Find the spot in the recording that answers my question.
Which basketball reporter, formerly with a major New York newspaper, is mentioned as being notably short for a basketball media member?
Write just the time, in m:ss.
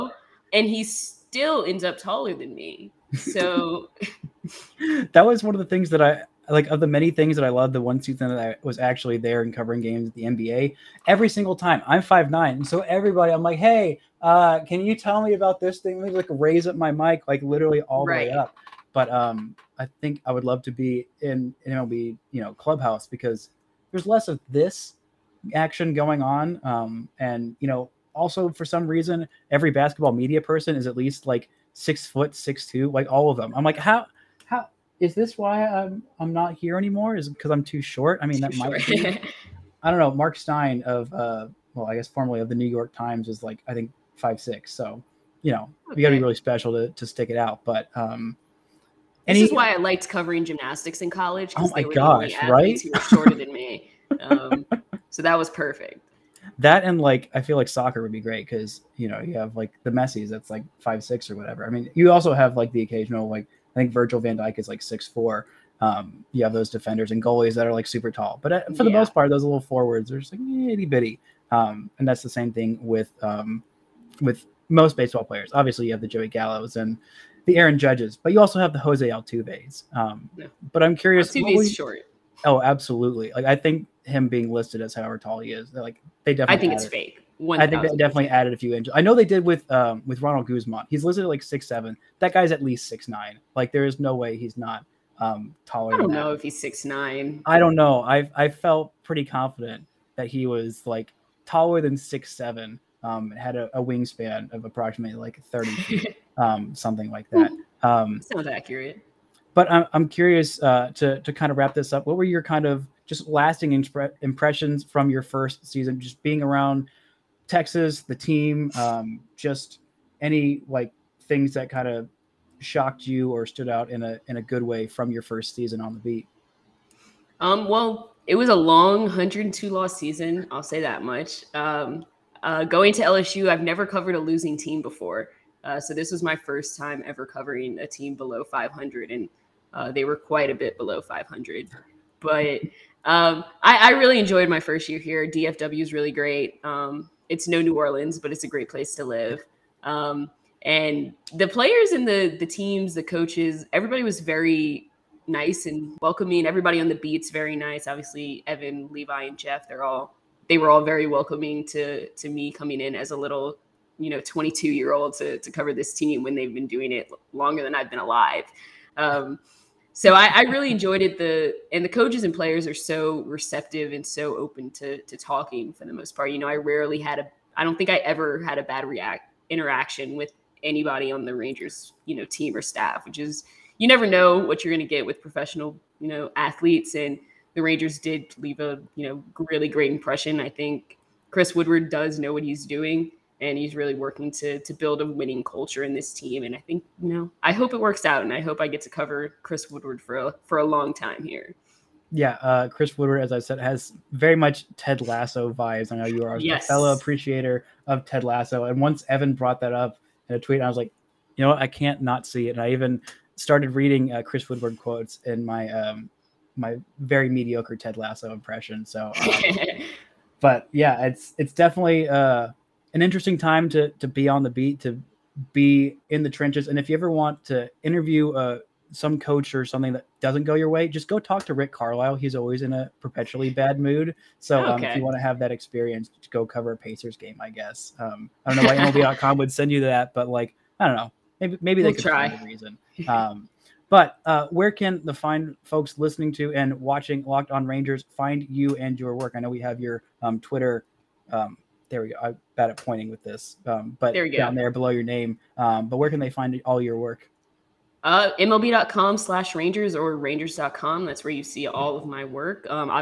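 0:40.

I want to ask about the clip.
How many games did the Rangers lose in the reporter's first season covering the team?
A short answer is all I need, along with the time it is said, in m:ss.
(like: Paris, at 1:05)
102, at 2:09.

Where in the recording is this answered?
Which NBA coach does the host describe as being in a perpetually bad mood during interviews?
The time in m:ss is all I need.
3:51.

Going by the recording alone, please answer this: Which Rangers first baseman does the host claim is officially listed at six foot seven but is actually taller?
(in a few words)
Ronald Guzman.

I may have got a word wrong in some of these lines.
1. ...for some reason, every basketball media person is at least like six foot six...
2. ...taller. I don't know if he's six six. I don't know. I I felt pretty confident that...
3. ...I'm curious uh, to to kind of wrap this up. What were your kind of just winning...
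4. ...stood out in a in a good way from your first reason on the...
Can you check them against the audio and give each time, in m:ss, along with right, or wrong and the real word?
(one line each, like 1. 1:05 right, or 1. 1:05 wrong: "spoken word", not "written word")
1. 0:28 right
2. 1:35 wrong: "nine", not "six"
3. 1:49 wrong: "lasting", not "winning"
4. 2:03 wrong: "season", not "reason".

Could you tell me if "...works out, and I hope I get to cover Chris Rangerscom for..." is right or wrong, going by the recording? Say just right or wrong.
wrong.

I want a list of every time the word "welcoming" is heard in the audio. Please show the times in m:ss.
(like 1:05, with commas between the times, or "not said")
2:35, 2:41.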